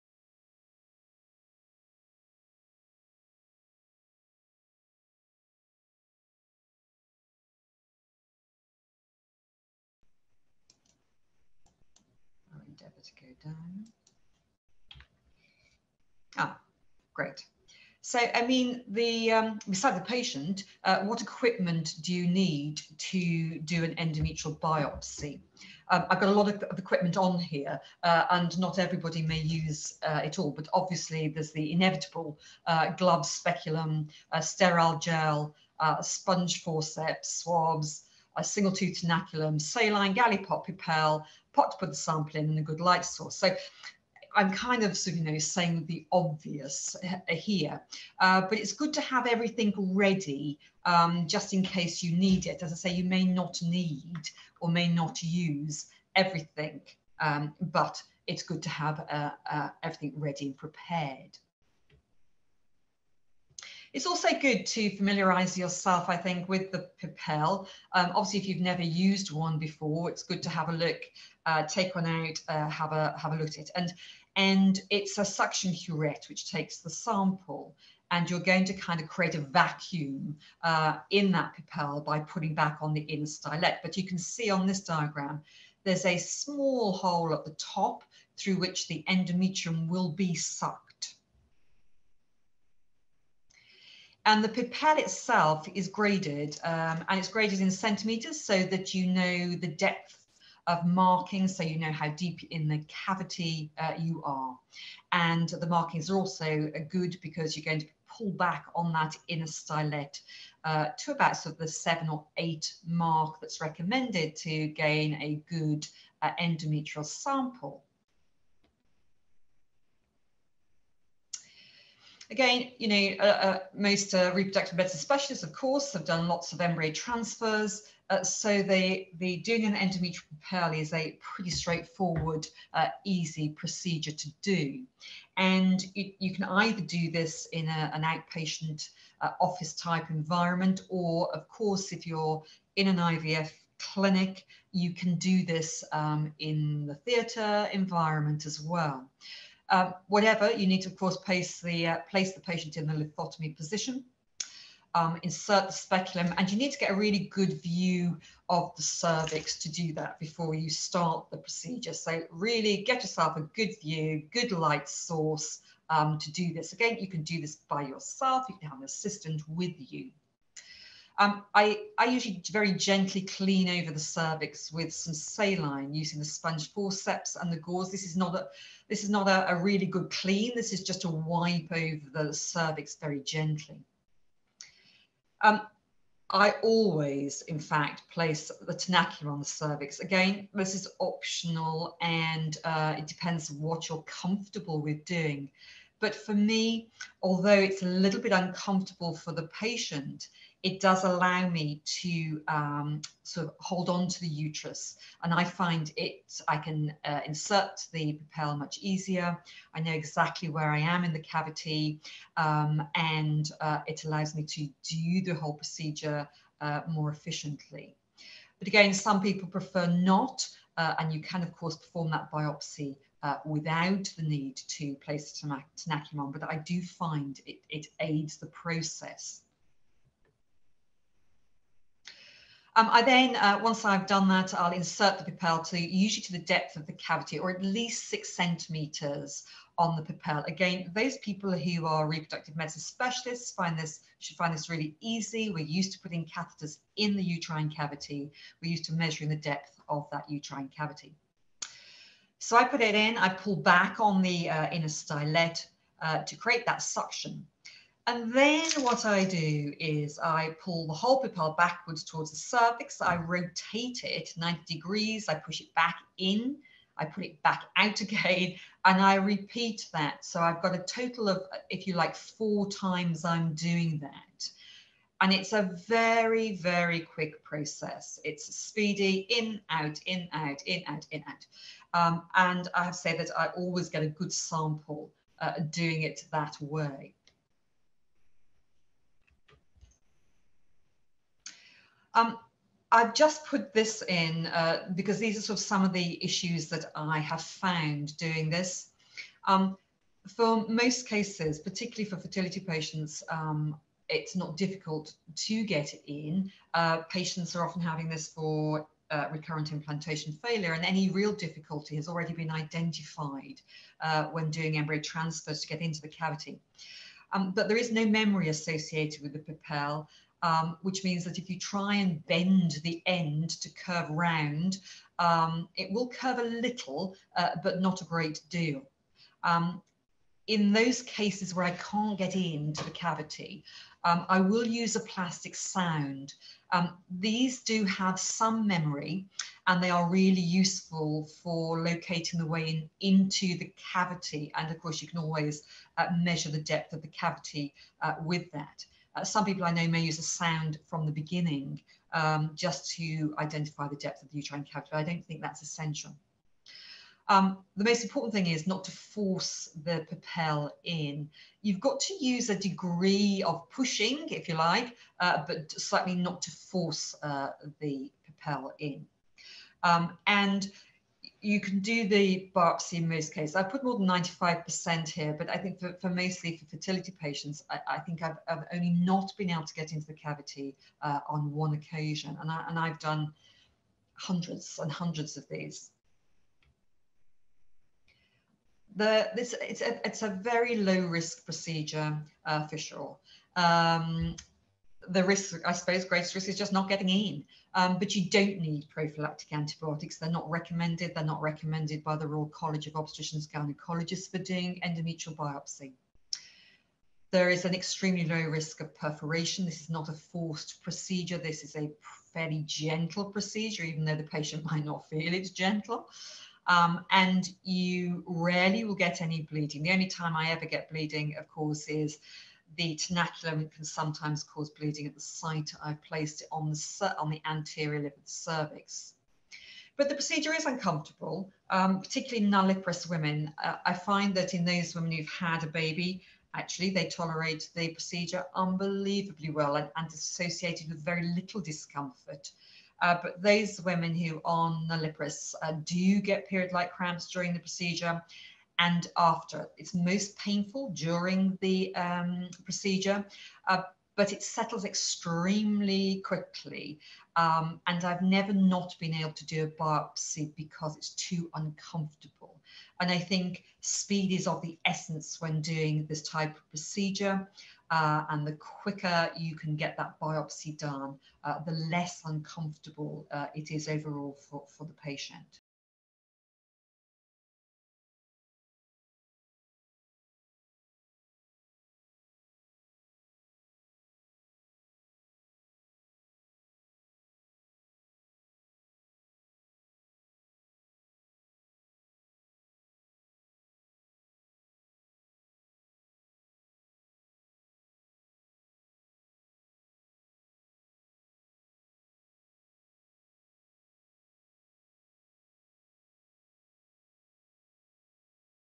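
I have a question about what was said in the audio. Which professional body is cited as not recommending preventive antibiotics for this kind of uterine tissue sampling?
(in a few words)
Royal College of Obstetricians and Gynecologists.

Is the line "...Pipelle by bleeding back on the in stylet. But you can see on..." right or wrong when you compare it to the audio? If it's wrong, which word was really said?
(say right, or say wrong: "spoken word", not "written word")
wrong: "putting", not "bleeding".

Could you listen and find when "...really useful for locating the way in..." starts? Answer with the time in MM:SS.
05:40.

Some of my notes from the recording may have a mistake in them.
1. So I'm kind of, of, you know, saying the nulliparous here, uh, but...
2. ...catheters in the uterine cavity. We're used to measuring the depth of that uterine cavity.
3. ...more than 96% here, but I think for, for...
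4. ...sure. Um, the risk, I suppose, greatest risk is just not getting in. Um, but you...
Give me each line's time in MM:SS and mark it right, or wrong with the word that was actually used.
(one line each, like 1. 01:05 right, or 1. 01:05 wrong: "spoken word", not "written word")
1. 00:43 wrong: "obvious", not "nulliparous"
2. 04:06 right
3. 06:13 wrong: "95", not "96"
4. 06:32 right.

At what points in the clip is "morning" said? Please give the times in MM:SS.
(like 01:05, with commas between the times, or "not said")
not said.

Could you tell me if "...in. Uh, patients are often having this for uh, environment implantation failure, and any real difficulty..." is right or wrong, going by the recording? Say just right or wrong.
wrong.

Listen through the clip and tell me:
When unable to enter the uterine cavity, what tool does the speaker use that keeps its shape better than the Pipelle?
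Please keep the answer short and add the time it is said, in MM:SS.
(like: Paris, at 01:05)
plastic sound, at 05:35.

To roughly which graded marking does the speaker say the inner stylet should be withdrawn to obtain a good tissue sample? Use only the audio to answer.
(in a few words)
7 or 8.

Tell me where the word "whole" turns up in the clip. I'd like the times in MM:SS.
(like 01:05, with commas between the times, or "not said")
03:35, 04:20.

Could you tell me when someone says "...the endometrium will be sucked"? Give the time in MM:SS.
01:28.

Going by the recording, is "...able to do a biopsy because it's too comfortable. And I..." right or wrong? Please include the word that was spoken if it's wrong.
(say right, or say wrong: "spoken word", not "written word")
wrong: "uncomfortable", not "comfortable".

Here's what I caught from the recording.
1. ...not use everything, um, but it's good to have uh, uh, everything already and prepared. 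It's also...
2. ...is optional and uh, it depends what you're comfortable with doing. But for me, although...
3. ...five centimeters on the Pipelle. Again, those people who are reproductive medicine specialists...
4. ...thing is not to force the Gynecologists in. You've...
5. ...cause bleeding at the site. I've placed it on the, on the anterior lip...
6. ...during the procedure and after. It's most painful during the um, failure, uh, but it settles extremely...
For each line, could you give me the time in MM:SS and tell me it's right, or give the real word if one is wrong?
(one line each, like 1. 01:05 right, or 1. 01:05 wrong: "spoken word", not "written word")
1. 00:54 wrong: "ready", not "already"
2. 03:10 right
3. 03:58 wrong: "six", not "five"
4. 05:58 wrong: "Pipelle", not "Gynecologists"
5. 07:04 right
6. 07:27 wrong: "procedure", not "failure".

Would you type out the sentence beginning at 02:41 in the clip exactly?
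So really get yourself a good view, good light source um, to do this.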